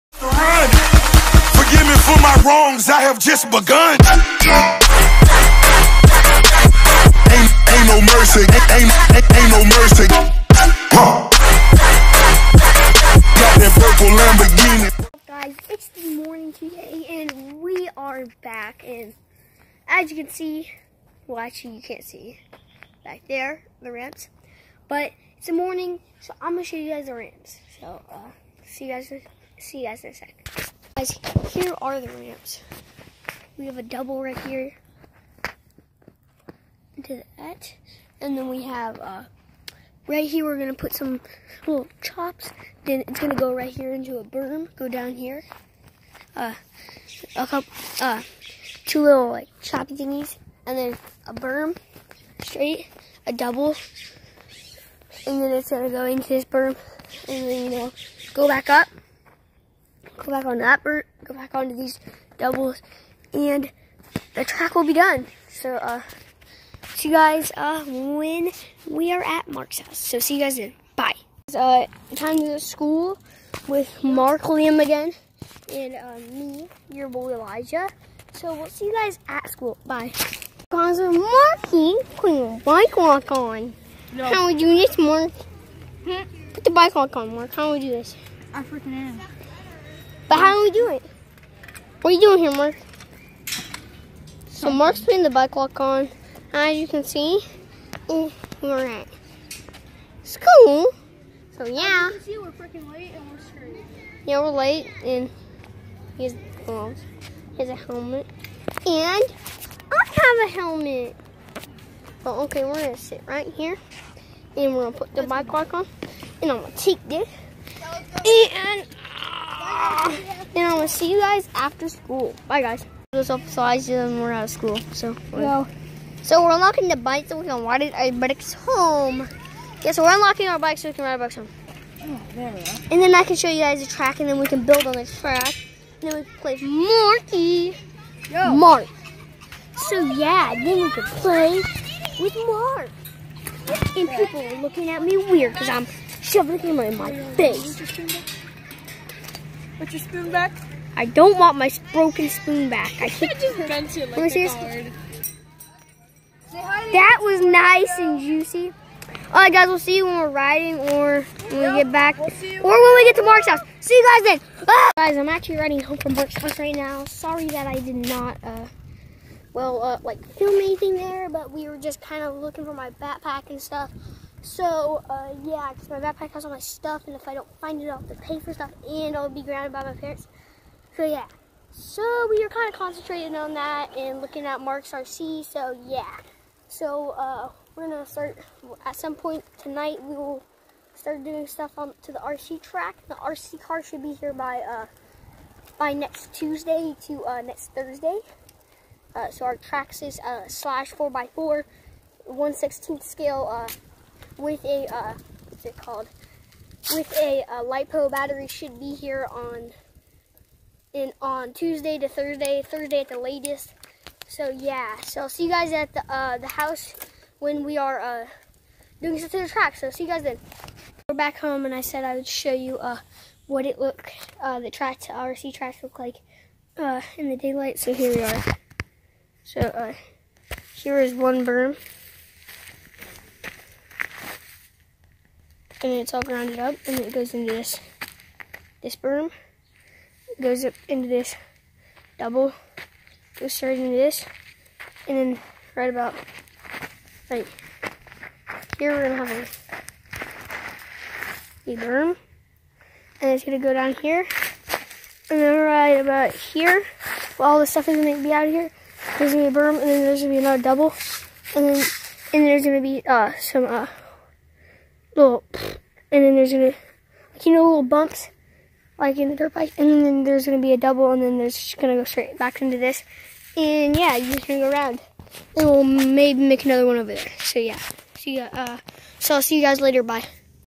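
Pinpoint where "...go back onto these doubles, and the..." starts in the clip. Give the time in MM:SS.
01:01.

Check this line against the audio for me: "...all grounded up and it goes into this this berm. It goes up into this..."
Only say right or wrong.
right.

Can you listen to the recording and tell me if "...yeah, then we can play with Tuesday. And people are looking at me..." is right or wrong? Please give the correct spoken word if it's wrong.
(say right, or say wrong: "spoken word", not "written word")
wrong: "Mark", not "Tuesday".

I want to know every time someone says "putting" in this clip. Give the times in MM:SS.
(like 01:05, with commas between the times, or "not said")
01:21, 01:35.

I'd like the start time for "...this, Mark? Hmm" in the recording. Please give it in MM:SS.
01:24.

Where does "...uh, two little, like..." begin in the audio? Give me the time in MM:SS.
00:48.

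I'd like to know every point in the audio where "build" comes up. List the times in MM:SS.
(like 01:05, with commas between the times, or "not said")
02:14.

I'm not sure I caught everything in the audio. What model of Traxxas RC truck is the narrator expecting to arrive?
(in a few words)
Slash 4x4.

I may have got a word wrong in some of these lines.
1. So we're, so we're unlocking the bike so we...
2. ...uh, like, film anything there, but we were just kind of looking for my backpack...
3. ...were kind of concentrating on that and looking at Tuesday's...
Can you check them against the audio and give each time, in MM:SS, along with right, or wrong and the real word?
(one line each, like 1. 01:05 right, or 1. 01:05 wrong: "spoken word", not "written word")
1. 02:04 right
2. 02:49 right
3. 03:02 wrong: "Mark", not "Tuesday".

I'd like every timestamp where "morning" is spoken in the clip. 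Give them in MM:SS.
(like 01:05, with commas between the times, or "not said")
00:16, 00:25.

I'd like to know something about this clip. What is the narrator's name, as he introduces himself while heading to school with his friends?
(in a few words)
Elijah.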